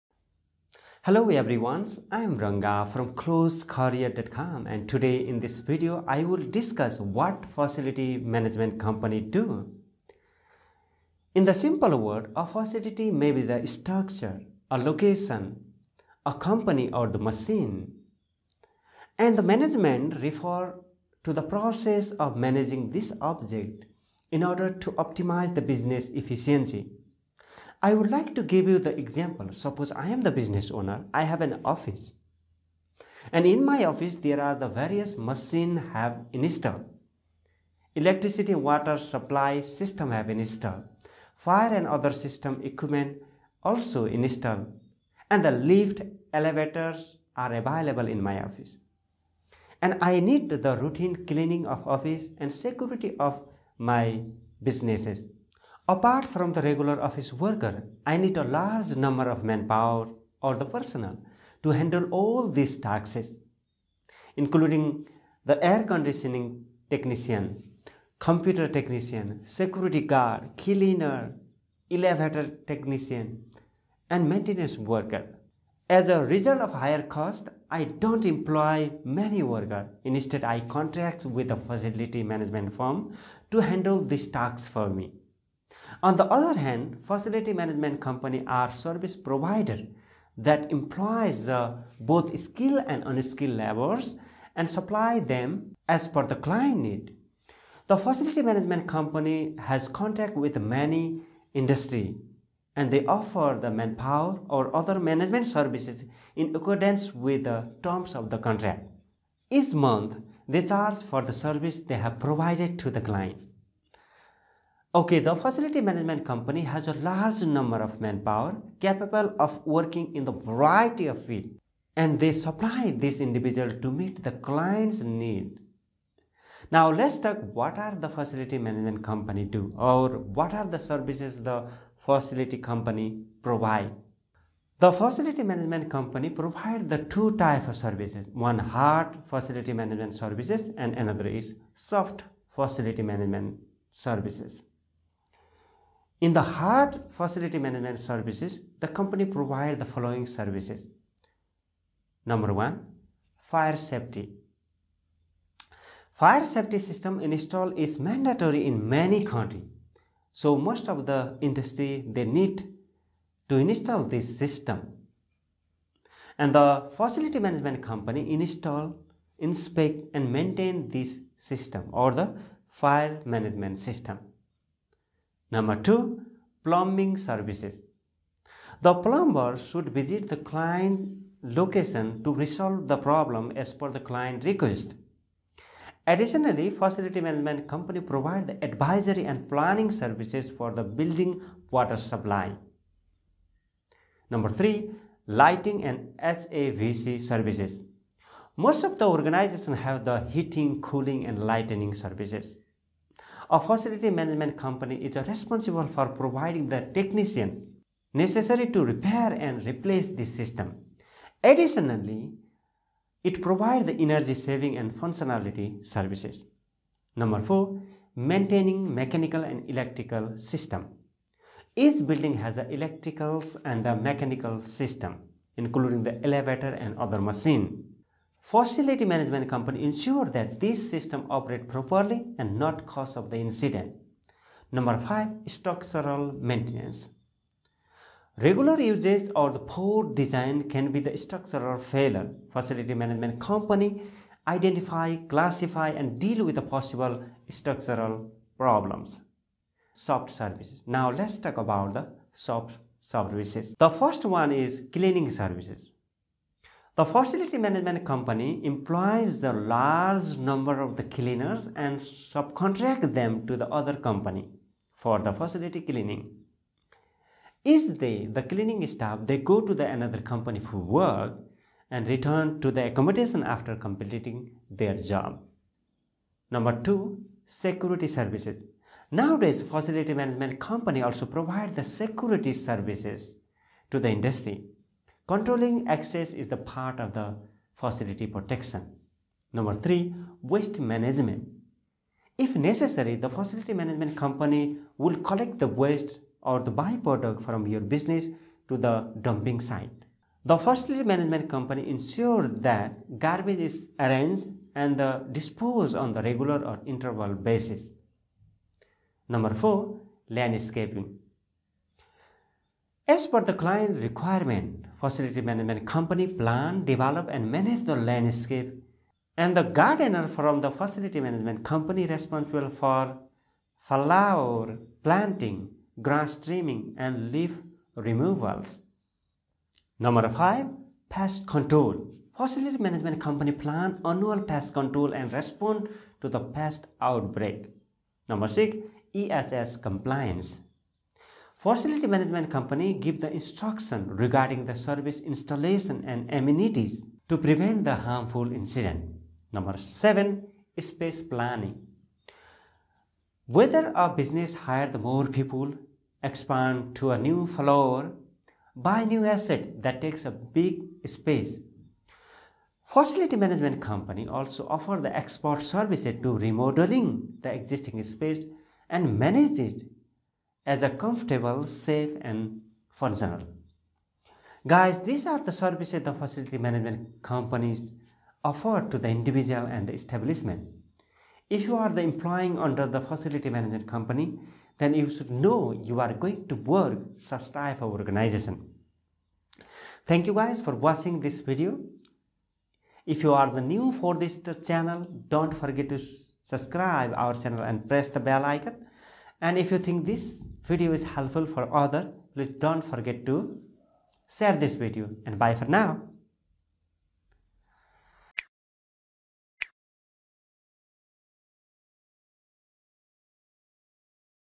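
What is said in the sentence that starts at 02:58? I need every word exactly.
The plumber should visit the client location to resolve the problem as per the client request.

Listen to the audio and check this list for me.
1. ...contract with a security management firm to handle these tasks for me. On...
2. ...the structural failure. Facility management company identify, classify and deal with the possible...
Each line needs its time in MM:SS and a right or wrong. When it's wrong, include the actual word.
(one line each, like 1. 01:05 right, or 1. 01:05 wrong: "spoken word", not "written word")
1. 01:20 wrong: "facility", not "security"
2. 04:01 right.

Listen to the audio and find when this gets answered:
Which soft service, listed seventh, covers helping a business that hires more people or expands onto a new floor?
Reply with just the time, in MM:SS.
05:50.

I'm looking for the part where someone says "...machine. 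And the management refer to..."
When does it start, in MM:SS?
00:17.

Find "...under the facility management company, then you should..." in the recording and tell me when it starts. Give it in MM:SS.
06:22.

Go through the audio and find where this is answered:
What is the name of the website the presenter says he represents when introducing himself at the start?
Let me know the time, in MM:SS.
00:03.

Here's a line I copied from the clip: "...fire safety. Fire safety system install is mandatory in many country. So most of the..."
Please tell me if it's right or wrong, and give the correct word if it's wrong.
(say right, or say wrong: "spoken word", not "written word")
right.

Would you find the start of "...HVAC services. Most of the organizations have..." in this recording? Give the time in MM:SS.
03:16.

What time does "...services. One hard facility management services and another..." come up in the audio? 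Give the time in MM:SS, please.
02:17.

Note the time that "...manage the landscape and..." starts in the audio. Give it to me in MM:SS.
05:17.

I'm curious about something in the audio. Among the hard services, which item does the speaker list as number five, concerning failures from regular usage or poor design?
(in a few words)
Structural maintenance.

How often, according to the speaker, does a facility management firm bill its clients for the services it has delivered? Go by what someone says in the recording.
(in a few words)
Each month.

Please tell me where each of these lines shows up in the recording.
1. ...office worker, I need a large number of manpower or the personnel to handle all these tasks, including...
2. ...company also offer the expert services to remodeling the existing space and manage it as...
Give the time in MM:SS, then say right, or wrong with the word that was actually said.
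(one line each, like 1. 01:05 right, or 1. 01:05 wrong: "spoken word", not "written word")
1. 00:57 right
2. 06:03 right.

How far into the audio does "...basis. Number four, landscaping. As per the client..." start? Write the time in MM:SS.
05:07.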